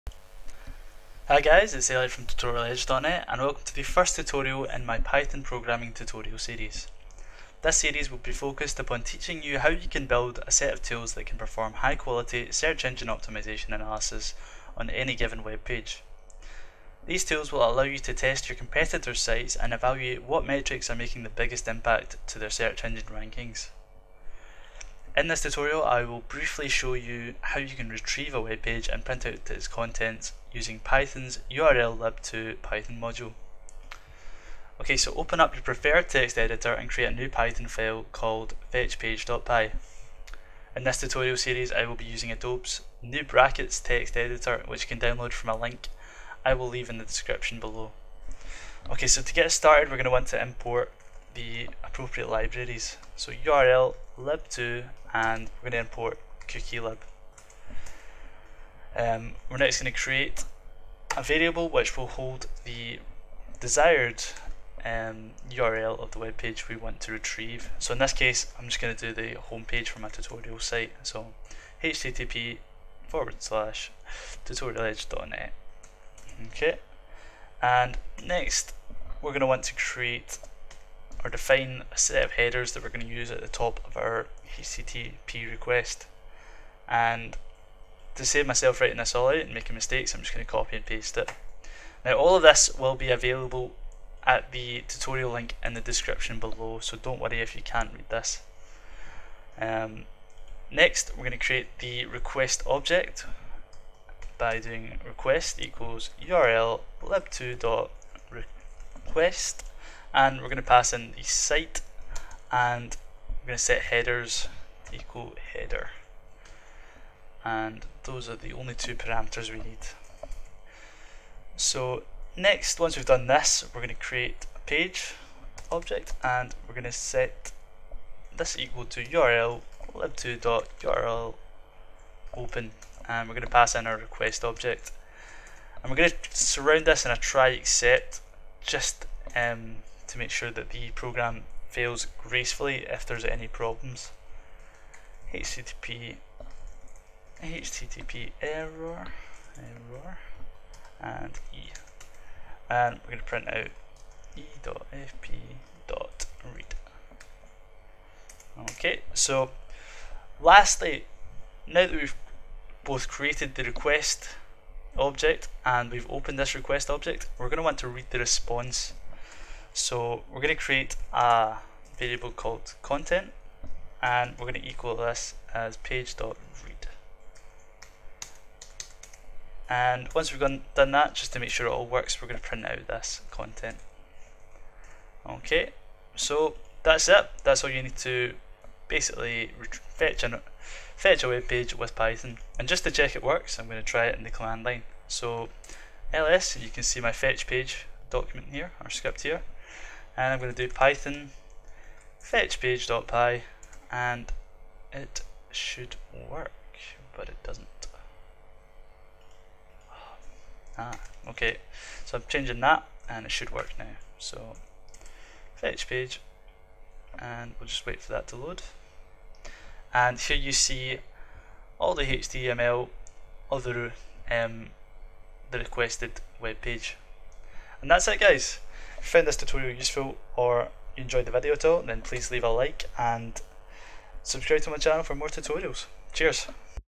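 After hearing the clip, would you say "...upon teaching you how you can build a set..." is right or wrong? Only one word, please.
right.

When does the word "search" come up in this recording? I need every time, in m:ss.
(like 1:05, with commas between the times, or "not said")
0:12, 0:22.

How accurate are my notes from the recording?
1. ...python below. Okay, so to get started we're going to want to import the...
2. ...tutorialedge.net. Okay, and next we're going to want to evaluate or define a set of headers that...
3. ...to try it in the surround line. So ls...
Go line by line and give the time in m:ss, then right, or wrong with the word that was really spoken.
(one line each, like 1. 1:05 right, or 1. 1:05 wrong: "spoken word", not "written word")
1. 0:47 wrong: "description", not "python"
2. 1:14 wrong: "create", not "evaluate"
3. 3:13 wrong: "command", not "surround".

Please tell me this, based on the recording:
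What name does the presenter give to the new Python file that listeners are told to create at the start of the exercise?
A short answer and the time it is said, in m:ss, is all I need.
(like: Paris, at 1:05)
fetchpage.py, at 0:38.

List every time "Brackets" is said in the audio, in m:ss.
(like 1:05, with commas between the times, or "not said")
0:43.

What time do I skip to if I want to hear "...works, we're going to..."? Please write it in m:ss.
3:01.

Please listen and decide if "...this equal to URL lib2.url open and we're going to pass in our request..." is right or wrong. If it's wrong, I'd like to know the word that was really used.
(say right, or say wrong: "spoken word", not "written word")
right.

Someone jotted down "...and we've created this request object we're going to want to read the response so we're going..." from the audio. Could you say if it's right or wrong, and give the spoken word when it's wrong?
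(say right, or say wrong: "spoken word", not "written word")
wrong: "opened", not "created".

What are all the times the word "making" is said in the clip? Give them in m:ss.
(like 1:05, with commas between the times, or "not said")
0:20, 1:29.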